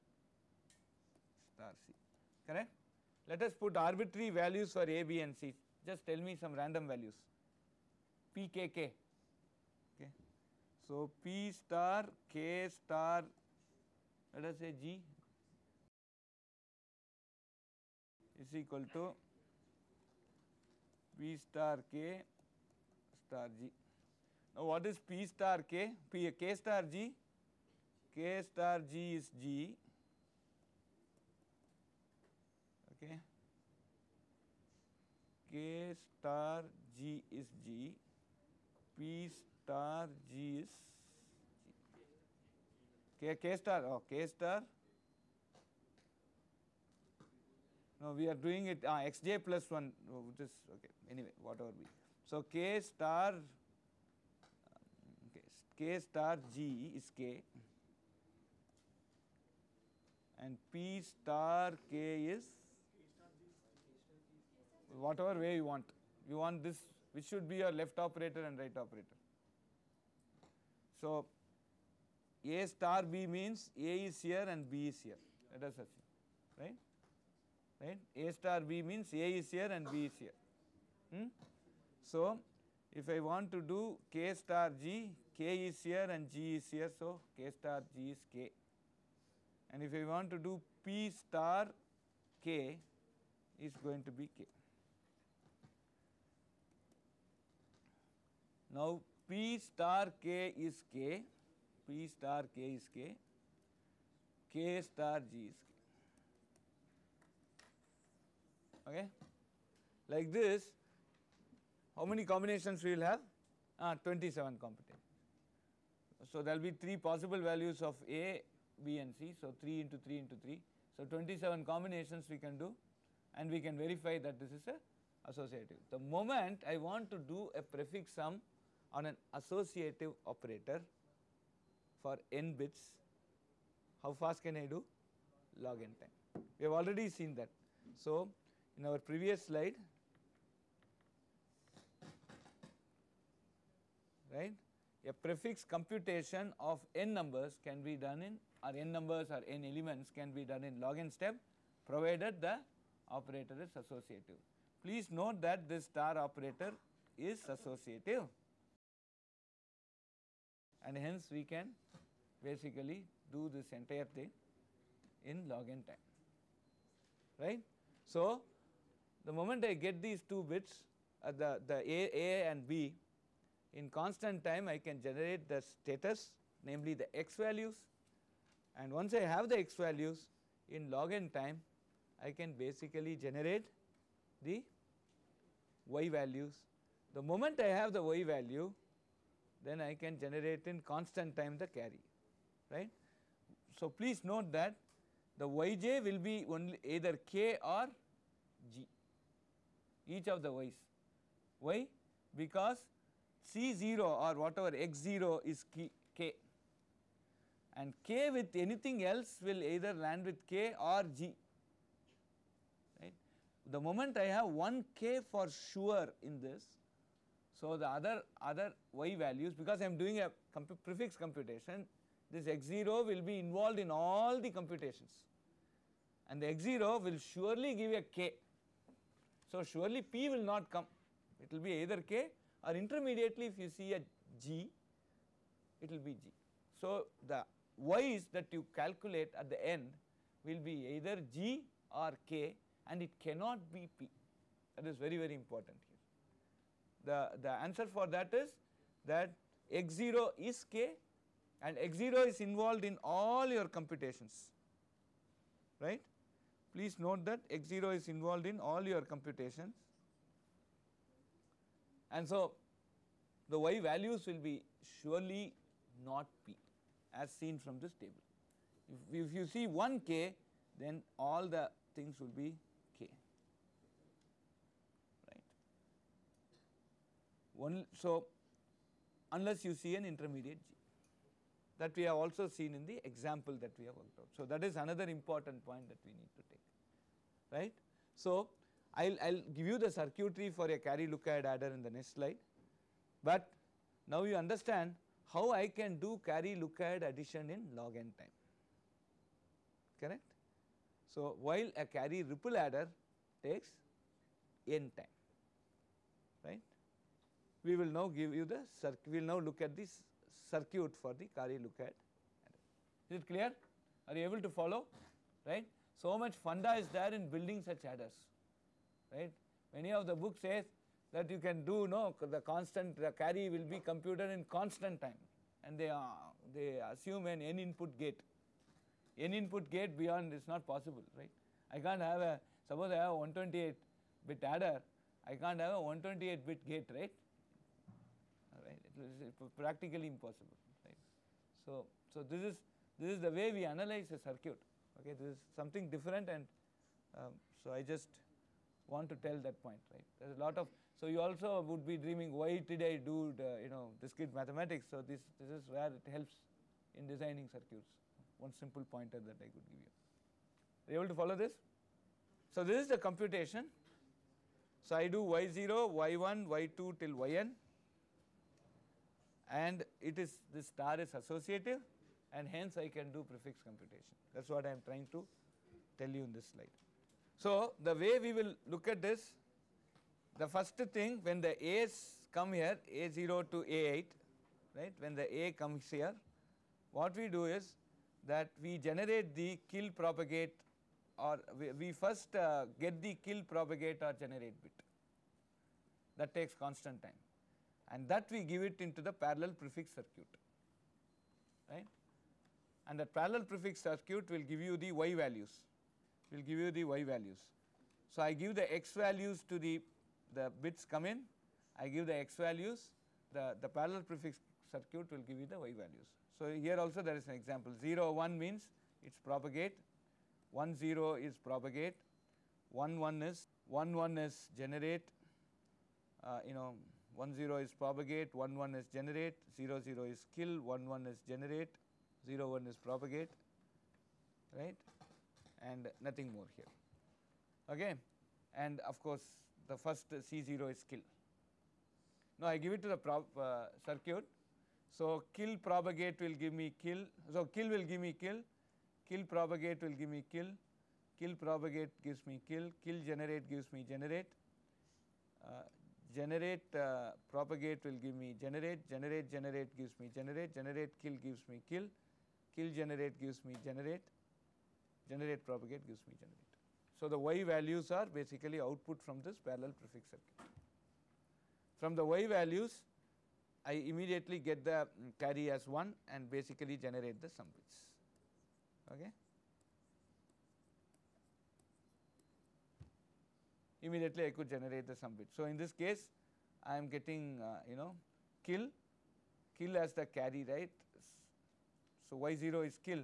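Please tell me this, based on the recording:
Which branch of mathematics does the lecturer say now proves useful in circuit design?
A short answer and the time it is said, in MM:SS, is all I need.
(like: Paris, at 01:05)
discrete mathematics, at 05:53.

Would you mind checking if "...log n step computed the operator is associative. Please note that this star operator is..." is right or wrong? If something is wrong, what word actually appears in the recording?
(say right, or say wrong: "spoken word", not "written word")
wrong: "provided", not "computed".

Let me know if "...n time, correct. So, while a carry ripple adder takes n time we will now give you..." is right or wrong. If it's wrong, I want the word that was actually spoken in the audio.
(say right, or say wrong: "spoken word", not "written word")
right.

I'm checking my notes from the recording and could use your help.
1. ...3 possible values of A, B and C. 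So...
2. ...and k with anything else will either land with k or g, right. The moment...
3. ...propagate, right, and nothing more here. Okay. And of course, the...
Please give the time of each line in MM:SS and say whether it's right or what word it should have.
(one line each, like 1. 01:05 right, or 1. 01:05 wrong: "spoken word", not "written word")
1. 01:56 right
2. 03:27 right
3. 07:12 right.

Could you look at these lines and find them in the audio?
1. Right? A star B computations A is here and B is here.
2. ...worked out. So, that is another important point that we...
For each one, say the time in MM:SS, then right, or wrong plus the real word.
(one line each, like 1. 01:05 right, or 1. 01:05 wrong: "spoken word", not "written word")
1. 01:17 wrong: "means", not "computations"
2. 04:43 right.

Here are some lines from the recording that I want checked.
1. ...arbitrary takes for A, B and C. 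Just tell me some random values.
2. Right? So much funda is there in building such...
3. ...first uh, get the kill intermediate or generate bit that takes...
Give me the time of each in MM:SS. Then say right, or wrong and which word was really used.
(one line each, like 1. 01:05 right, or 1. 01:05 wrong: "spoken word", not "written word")
1. 00:03 wrong: "values", not "takes"
2. 05:15 right
3. 06:31 wrong: "propagate", not "intermediate".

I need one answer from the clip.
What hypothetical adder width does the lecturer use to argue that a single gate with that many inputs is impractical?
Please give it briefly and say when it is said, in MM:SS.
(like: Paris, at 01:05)
128 bit, at 05:33.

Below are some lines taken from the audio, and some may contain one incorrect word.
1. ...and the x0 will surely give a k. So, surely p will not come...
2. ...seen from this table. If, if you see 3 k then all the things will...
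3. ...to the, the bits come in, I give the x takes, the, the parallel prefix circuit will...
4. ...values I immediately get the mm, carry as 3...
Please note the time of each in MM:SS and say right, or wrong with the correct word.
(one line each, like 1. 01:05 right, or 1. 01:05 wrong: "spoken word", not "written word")
1. 03:46 right
2. 04:27 wrong: "1", not "3"
3. 06:49 wrong: "values", not "takes"
4. 07:52 wrong: "1", not "3".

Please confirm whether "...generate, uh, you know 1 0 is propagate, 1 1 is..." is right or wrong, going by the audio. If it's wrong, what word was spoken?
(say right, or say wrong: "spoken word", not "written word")
right.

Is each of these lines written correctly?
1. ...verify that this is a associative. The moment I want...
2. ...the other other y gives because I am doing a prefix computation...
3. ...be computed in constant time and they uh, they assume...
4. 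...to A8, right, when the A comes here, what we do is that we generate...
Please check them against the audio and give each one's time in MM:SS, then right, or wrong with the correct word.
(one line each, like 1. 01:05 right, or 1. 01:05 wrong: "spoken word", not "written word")
1. 02:03 right
2. 03:37 wrong: "values", not "gives"
3. 05:23 right
4. 06:23 right.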